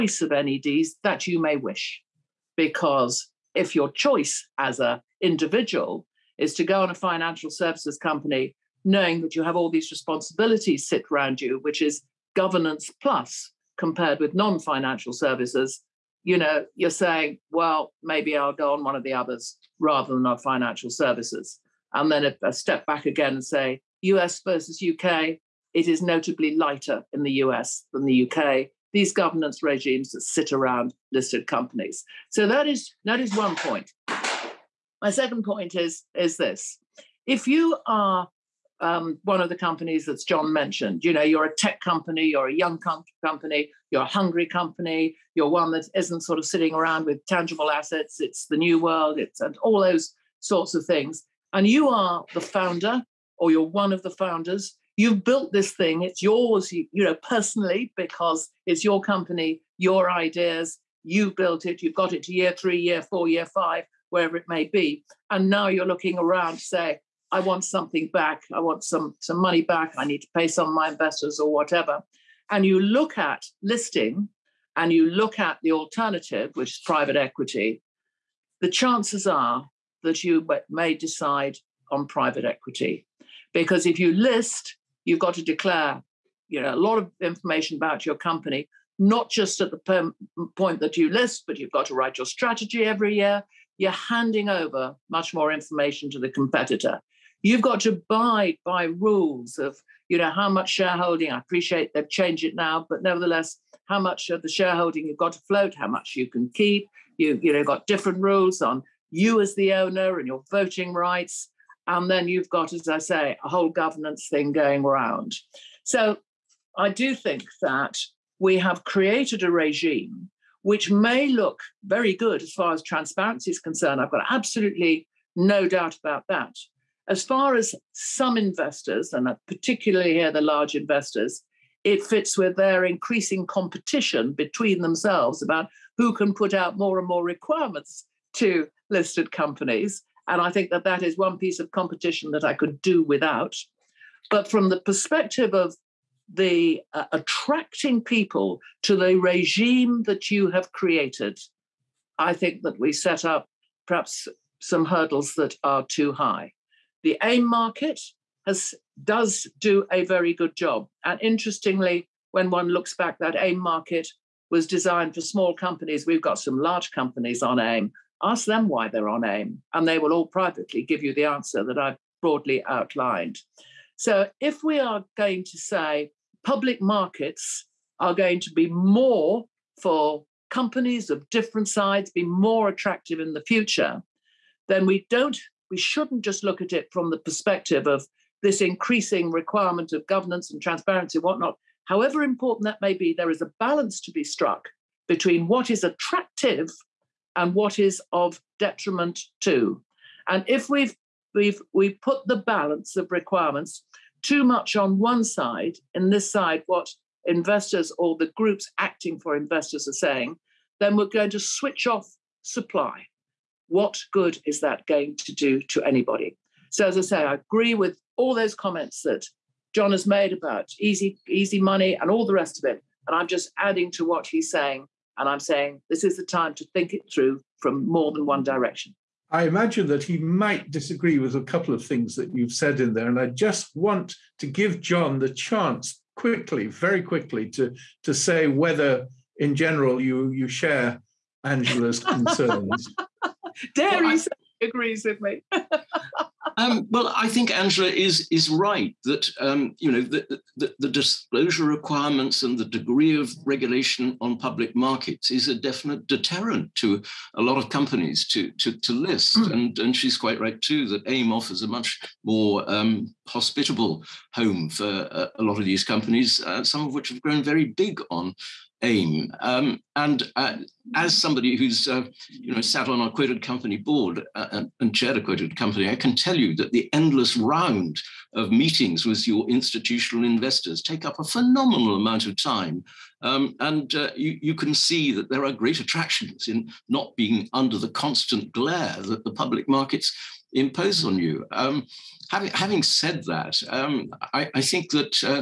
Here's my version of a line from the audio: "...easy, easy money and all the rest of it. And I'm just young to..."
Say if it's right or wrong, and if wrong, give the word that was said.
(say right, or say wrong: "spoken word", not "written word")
wrong: "adding", not "young".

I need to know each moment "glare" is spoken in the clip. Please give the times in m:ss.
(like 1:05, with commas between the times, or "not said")
4:48.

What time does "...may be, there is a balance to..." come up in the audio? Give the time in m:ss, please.
3:12.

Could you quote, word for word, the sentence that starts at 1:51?
And then you've got, as I say, a whole governance thing going round.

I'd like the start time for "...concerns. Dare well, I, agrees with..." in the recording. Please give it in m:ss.
4:02.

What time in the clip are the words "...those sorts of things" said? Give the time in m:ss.
0:49.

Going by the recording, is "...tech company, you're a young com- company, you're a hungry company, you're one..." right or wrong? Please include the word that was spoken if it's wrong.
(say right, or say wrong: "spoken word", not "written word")
right.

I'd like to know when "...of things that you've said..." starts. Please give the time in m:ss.
3:51.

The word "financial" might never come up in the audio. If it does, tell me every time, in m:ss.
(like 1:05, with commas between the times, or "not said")
0:06, 0:14, 0:20.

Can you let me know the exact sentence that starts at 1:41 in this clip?
I appreciate they've changed it now, but nevertheless, how much of the shareholding you've got to float, how much you can keep.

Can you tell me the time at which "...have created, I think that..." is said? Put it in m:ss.
2:30.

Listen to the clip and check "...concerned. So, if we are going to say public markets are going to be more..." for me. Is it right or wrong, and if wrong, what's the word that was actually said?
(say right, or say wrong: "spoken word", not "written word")
wrong: "outlined", not "concerned".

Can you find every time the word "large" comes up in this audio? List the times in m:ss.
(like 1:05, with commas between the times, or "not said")
2:10, 2:46.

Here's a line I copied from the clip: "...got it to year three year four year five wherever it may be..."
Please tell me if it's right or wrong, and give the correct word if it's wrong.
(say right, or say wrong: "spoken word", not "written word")
right.